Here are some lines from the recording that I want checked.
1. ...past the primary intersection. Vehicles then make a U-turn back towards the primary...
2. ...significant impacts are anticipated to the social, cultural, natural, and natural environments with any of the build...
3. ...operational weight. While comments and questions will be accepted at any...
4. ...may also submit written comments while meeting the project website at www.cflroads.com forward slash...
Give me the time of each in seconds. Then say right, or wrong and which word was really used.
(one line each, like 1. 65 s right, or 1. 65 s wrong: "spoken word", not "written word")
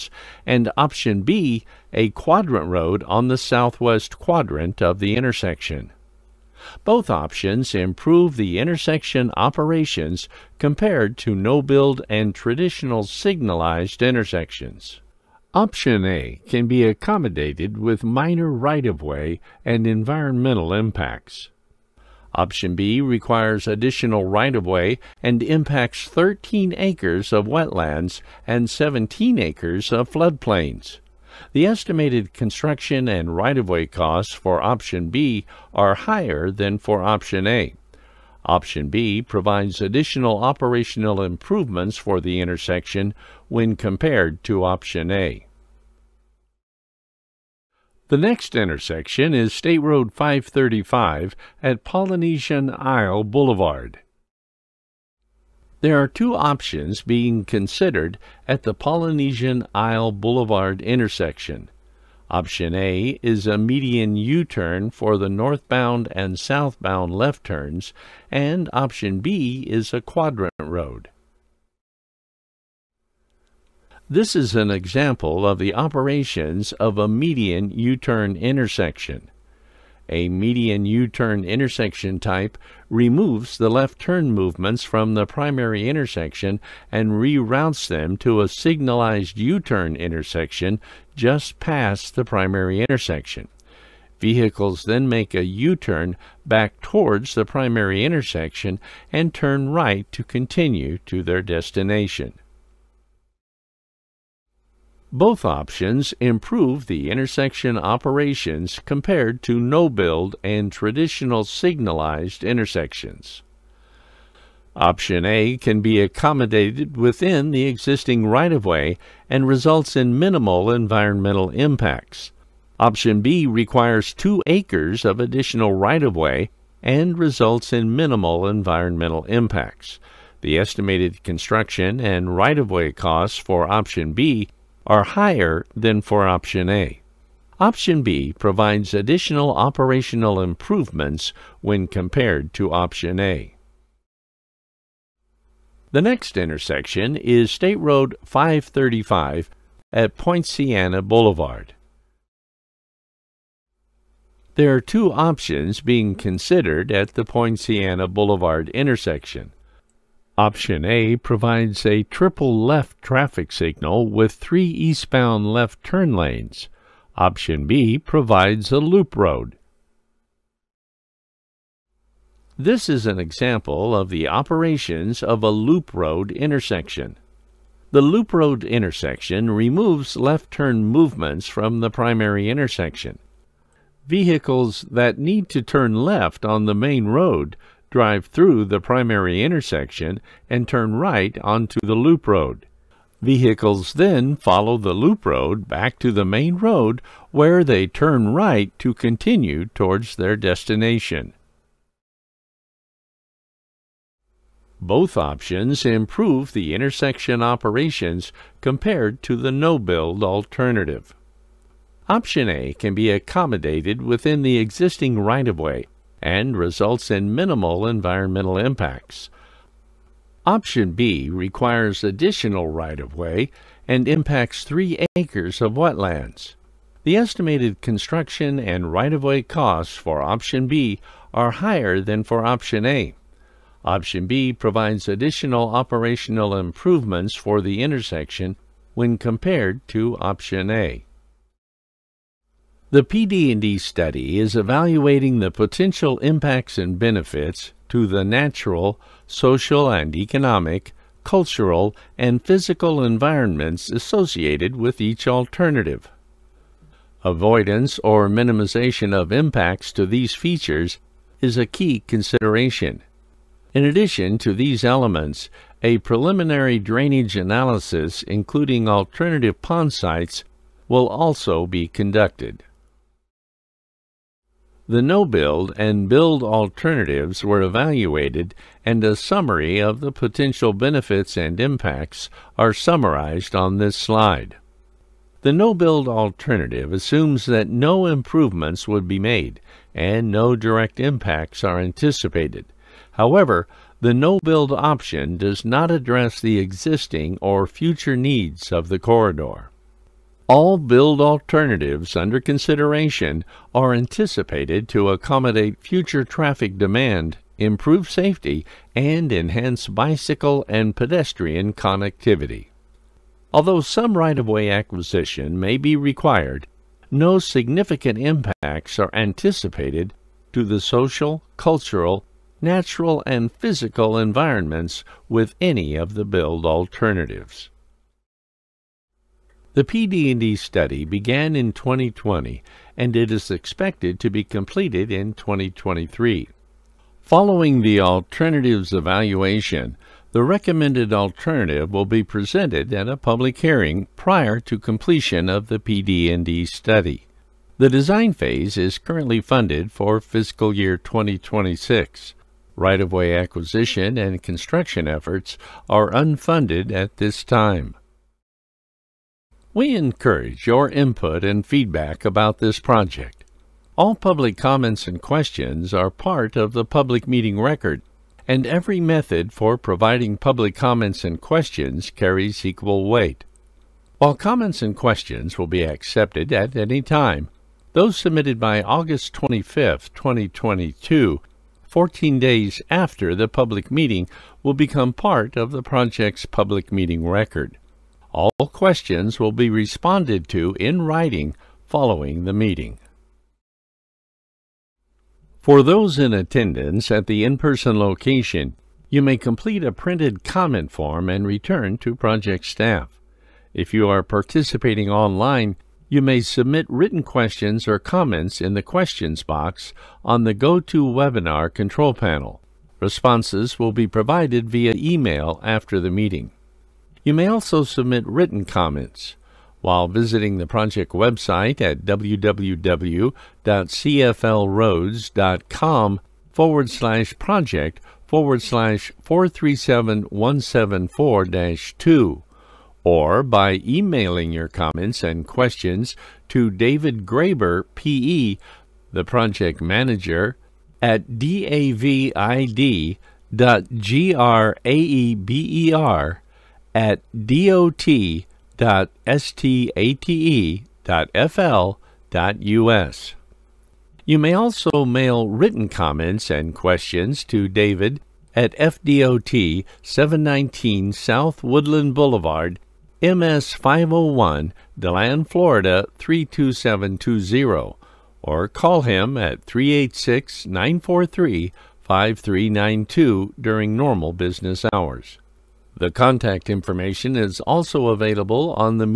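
1. 91 s right
2. 317 s wrong: "physical", not "natural"
3. 372 s wrong: "equal", not "operational"
4. 417 s wrong: "visiting", not "meeting".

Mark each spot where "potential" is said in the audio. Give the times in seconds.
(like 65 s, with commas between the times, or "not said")
245 s, 280 s.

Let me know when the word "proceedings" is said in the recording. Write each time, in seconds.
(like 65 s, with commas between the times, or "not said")
not said.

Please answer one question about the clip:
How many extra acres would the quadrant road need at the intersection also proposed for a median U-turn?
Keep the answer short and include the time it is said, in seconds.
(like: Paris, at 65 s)
2, at 124 s.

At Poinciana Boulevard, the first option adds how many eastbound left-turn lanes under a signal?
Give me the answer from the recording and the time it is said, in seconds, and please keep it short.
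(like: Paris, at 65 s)
3, at 164 s.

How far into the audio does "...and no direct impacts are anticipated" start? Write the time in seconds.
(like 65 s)
289 s.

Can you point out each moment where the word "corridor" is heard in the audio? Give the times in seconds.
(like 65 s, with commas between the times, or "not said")
298 s.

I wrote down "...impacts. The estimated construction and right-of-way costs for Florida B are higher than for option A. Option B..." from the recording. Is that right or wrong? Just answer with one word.
wrong.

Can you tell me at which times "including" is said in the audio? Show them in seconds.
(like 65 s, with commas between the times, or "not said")
268 s.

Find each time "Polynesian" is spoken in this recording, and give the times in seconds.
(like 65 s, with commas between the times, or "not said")
51 s, 58 s.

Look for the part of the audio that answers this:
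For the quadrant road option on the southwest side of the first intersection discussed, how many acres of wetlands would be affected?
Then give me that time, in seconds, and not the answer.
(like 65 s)
26 s.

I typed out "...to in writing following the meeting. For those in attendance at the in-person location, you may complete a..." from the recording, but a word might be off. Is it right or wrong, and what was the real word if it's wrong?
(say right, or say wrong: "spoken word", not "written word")
right.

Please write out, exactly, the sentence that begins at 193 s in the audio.
Vehicles then follow the loop road back to the main road where they turn right to continue towards their destination.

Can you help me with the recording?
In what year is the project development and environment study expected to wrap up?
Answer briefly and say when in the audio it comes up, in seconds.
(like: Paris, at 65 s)
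2023, at 335 s.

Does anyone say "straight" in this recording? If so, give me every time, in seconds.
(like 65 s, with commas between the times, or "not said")
not said.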